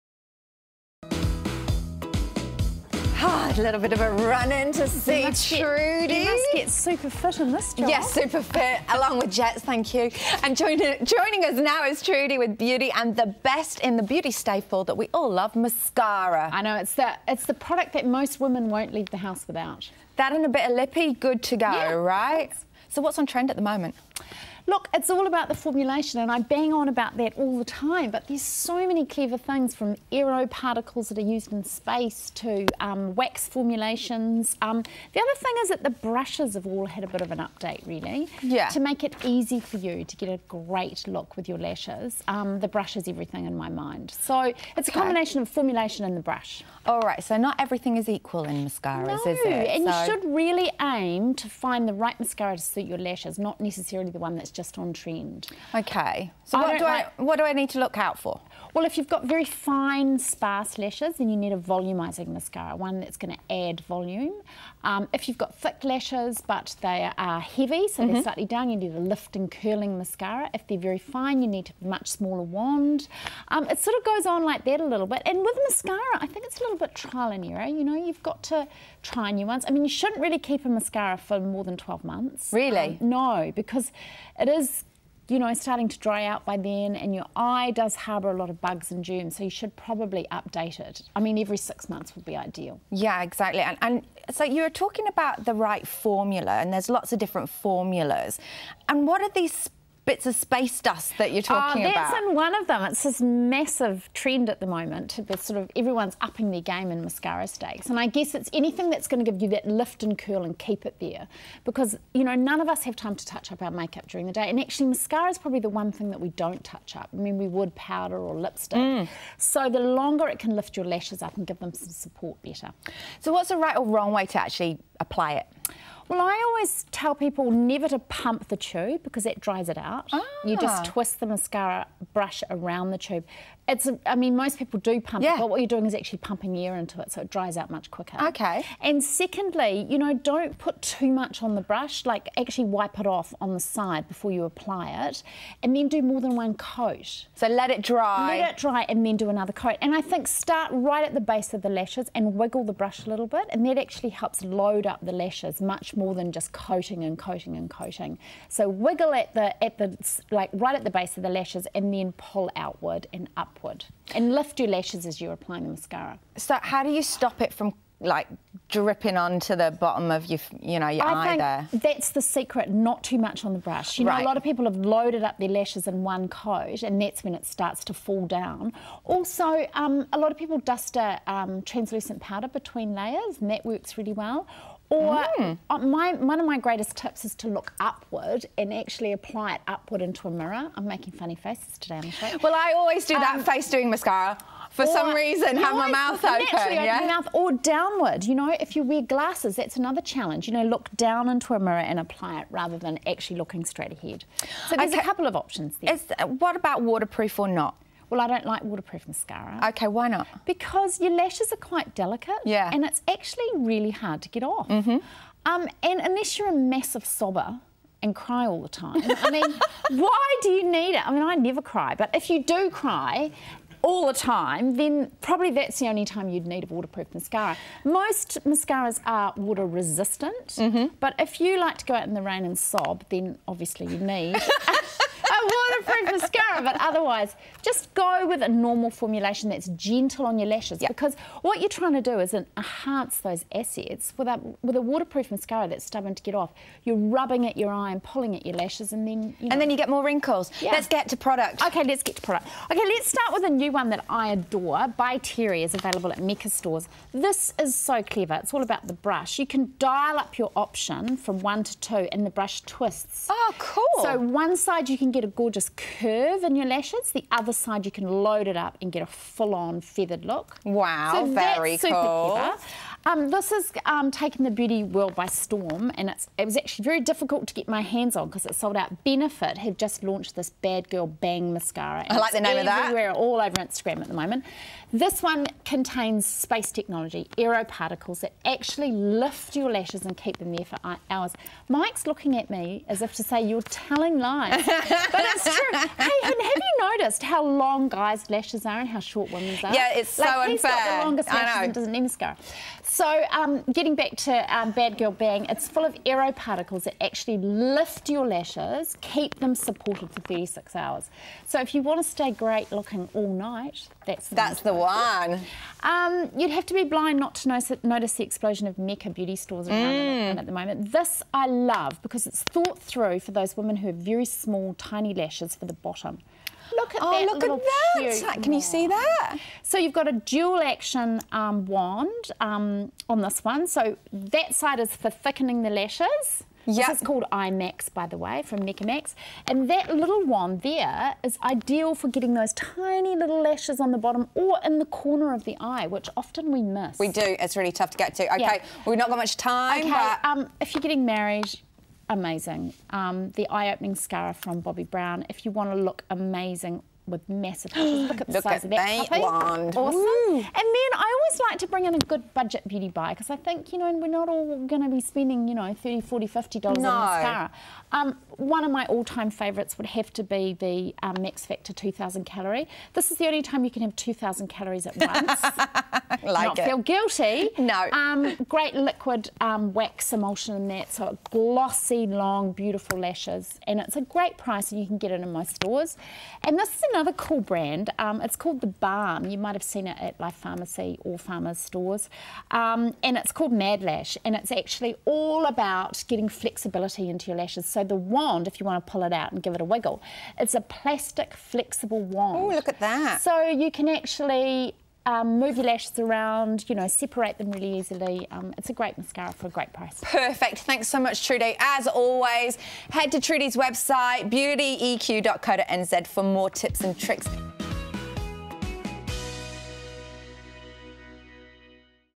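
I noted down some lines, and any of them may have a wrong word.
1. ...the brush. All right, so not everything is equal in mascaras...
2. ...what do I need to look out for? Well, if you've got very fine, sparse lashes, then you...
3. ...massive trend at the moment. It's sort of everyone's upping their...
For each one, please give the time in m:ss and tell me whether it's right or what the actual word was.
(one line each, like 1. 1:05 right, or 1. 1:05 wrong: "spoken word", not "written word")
1. 0:46 right
2. 0:57 right
3. 1:43 right.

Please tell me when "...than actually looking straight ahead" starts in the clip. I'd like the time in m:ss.
3:22.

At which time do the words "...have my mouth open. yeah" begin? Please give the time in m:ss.
3:15.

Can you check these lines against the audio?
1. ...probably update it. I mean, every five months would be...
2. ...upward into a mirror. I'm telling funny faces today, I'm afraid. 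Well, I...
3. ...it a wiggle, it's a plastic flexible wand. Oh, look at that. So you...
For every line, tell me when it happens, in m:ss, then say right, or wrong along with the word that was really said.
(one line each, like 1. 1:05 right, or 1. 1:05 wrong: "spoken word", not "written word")
1. 1:29 wrong: "six", not "five"
2. 3:09 wrong: "making", not "telling"
3. 6:39 right.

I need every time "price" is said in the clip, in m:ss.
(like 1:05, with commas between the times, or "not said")
6:24, 6:49.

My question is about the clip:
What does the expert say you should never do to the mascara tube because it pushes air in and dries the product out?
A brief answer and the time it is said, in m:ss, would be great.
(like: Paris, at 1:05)
pump the tube, at 2:07.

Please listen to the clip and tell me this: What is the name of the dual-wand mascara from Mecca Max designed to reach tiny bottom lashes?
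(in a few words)
IMAX.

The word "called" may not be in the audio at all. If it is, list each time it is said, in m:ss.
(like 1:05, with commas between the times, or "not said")
5:37, 6:28, 6:33.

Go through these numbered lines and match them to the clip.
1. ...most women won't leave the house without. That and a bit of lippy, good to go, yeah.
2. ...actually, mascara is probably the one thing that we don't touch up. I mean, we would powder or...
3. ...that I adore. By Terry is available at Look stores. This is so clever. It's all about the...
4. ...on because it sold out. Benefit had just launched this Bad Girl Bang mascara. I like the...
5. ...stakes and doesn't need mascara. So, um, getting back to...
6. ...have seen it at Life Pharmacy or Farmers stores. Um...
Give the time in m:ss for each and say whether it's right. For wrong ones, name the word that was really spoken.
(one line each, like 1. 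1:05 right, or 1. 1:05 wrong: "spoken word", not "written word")
1. 0:18 right
2. 1:54 right
3. 4:13 wrong: "Mecca", not "Look"
4. 4:38 right
5. 5:01 wrong: "lashes", not "stakes"
6. 6:29 right.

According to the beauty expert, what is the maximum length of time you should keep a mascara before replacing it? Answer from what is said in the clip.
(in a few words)
12 months.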